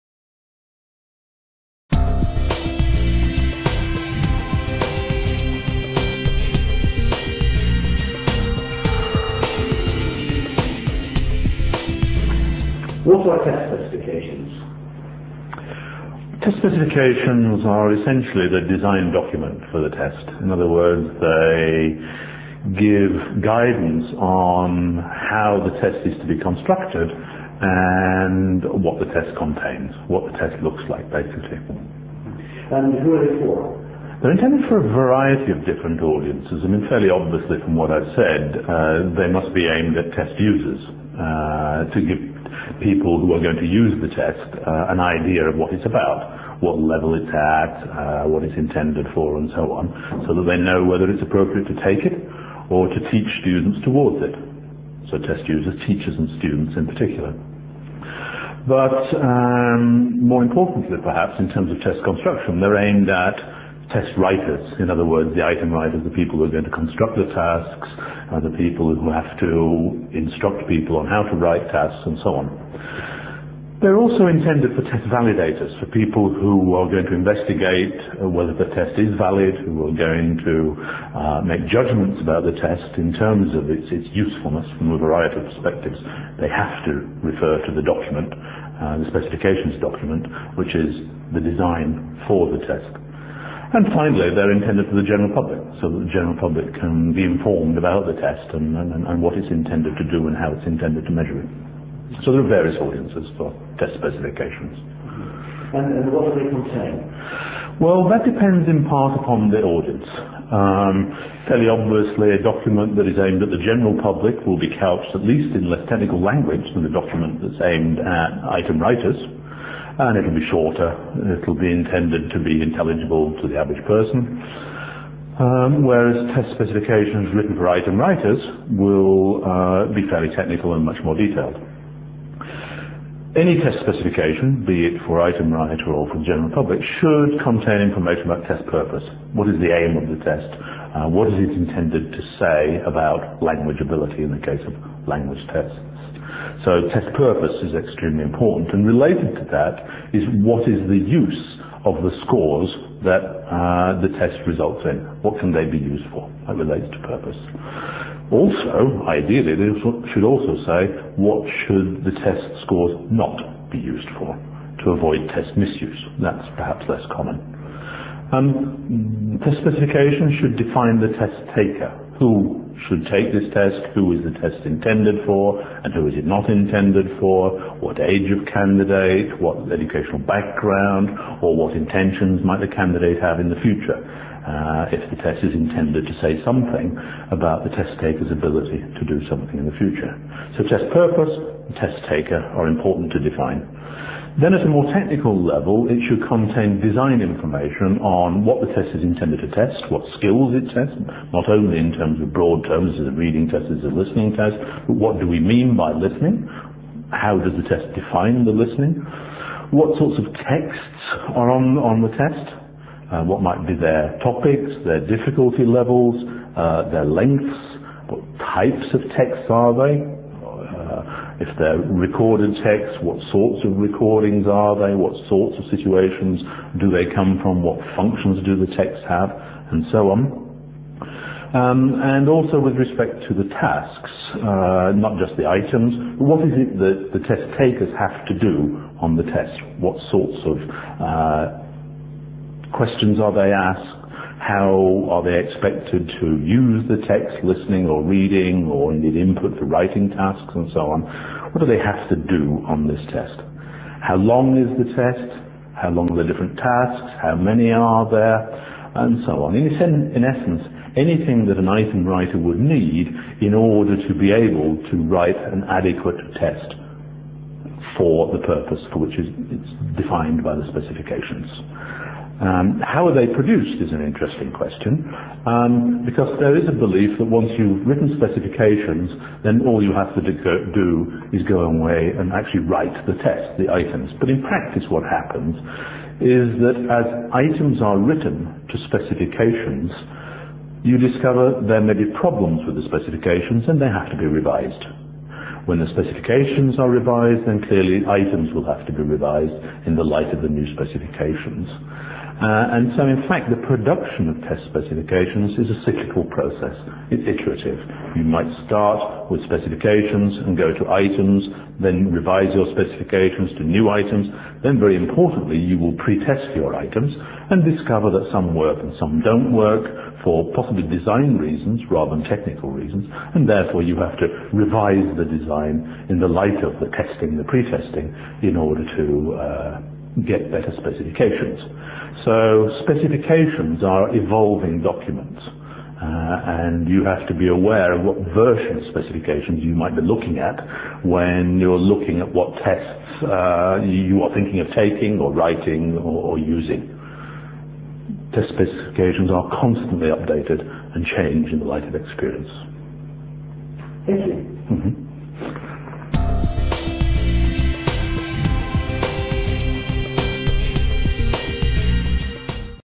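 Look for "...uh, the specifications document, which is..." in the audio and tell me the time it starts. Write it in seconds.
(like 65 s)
88 s.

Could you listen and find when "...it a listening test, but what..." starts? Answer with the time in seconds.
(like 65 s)
203 s.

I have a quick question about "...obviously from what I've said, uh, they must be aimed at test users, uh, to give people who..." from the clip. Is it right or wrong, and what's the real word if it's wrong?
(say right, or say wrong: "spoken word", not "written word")
right.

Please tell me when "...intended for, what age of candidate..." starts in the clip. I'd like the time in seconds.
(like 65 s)
176 s.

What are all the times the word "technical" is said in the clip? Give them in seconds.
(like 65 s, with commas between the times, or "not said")
115 s, 130 s, 194 s, 322 s.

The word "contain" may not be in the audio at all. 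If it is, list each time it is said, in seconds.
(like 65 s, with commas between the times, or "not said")
29 s, 106 s, 137 s, 196 s.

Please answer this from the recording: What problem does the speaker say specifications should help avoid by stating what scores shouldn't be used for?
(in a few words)
test misuse.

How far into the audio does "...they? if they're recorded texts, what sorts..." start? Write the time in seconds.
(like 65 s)
219 s.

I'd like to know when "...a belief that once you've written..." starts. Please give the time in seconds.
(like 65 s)
276 s.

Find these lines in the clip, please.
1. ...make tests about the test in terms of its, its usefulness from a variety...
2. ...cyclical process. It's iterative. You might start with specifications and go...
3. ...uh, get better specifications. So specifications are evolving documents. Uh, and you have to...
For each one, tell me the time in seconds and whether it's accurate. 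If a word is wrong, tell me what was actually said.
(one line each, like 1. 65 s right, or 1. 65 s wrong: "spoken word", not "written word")
1. 81 s wrong: "judgments", not "tests"
2. 305 s right
3. 329 s right.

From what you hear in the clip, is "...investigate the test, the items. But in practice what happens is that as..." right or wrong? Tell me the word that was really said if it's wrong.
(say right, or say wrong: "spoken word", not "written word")
wrong: "write", not "investigate".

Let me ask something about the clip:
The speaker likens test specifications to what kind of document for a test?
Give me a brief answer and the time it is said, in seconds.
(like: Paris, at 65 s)
design document, at 18 s.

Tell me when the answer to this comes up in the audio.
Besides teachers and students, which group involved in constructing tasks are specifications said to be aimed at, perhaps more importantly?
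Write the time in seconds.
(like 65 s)
63 s.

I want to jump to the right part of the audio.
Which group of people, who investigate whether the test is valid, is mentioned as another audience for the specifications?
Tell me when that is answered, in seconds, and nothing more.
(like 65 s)
74 s.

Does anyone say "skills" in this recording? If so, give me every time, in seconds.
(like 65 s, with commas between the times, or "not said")
200 s.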